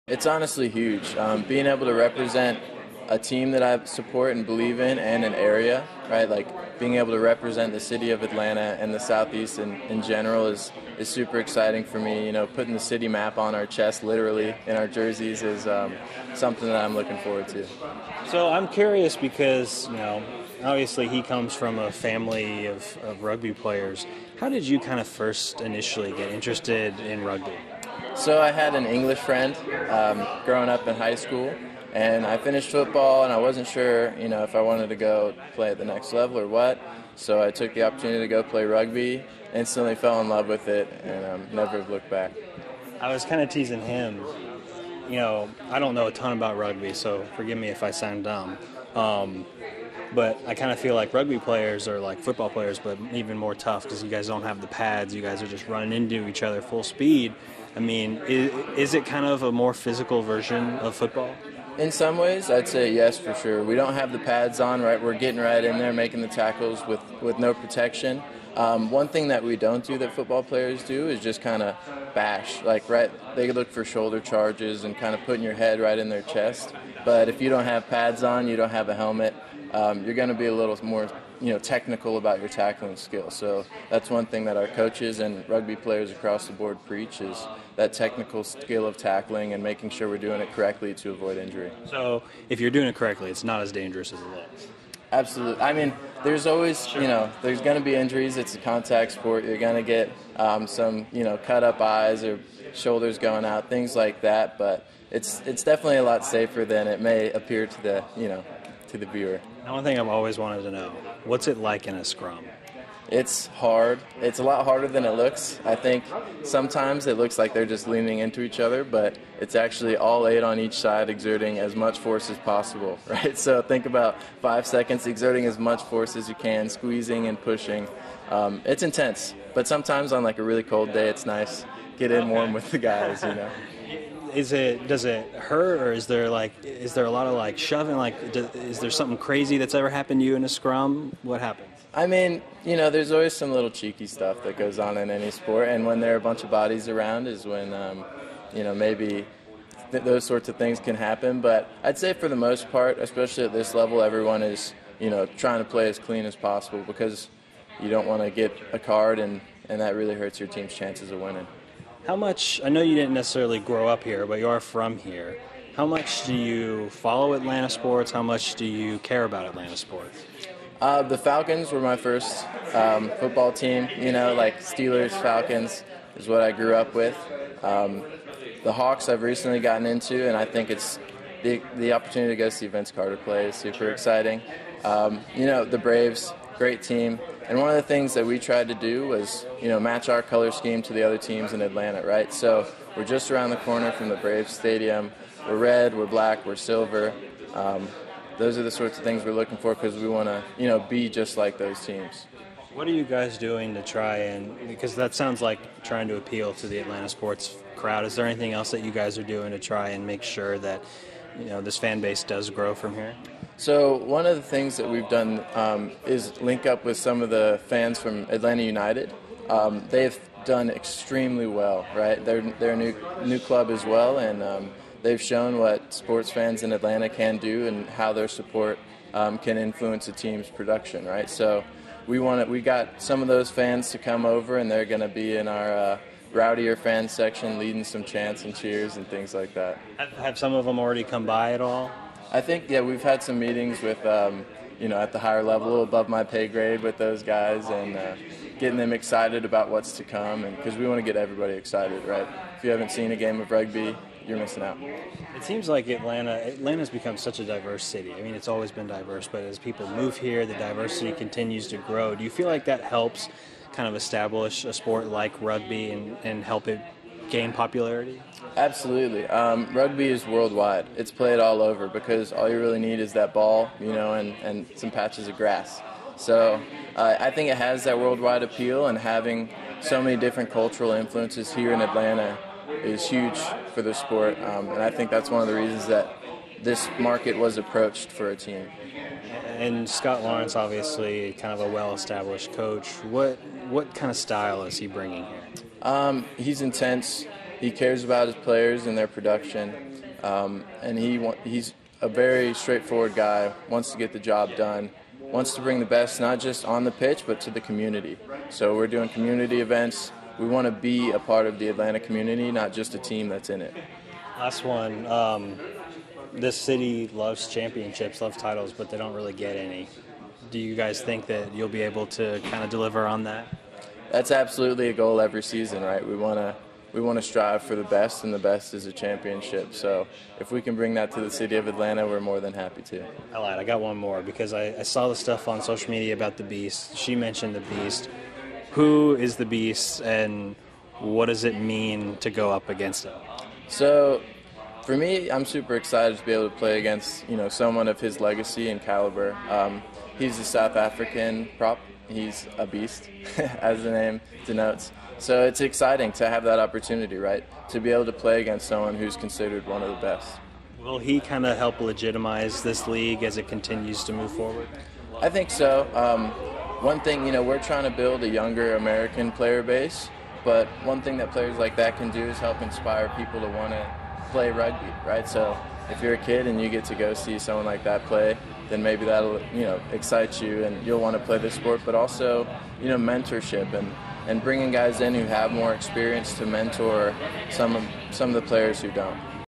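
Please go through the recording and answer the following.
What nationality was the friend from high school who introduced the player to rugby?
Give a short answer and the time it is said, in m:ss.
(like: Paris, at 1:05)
English, at 0:28.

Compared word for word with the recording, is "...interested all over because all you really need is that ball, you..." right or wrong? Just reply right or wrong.
wrong.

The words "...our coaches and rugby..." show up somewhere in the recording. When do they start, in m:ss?
1:24.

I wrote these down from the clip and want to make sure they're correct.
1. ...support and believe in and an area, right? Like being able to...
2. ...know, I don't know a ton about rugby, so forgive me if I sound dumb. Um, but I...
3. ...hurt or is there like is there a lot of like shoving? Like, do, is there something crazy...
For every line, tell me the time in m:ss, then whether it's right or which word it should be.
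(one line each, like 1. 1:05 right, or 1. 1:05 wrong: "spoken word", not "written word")
1. 0:03 right
2. 0:45 right
3. 2:15 right.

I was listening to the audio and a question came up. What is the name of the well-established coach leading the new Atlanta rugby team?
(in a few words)
Scott Lawrence.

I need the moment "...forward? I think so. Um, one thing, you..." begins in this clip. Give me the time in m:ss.
6:04.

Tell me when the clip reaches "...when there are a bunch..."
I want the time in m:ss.
2:25.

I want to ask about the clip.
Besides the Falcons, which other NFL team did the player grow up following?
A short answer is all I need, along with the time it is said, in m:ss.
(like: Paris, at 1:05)
Steelers, at 2:54.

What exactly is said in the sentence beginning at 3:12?
So we're just around the corner from the Braves Stadium.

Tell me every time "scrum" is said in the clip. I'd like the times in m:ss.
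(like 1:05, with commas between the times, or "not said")
1:52, 2:20.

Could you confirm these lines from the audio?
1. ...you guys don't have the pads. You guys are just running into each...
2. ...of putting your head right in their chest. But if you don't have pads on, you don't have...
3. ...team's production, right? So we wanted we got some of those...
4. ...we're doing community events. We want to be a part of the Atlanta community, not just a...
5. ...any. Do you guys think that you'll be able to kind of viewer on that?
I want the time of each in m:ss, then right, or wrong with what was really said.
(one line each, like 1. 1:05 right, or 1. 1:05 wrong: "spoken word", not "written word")
1. 0:54 right
2. 1:15 right
3. 3:50 right
4. 5:08 right
5. 5:19 wrong: "deliver", not "viewer".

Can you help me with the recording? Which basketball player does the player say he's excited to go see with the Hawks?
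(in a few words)
Vince Carter.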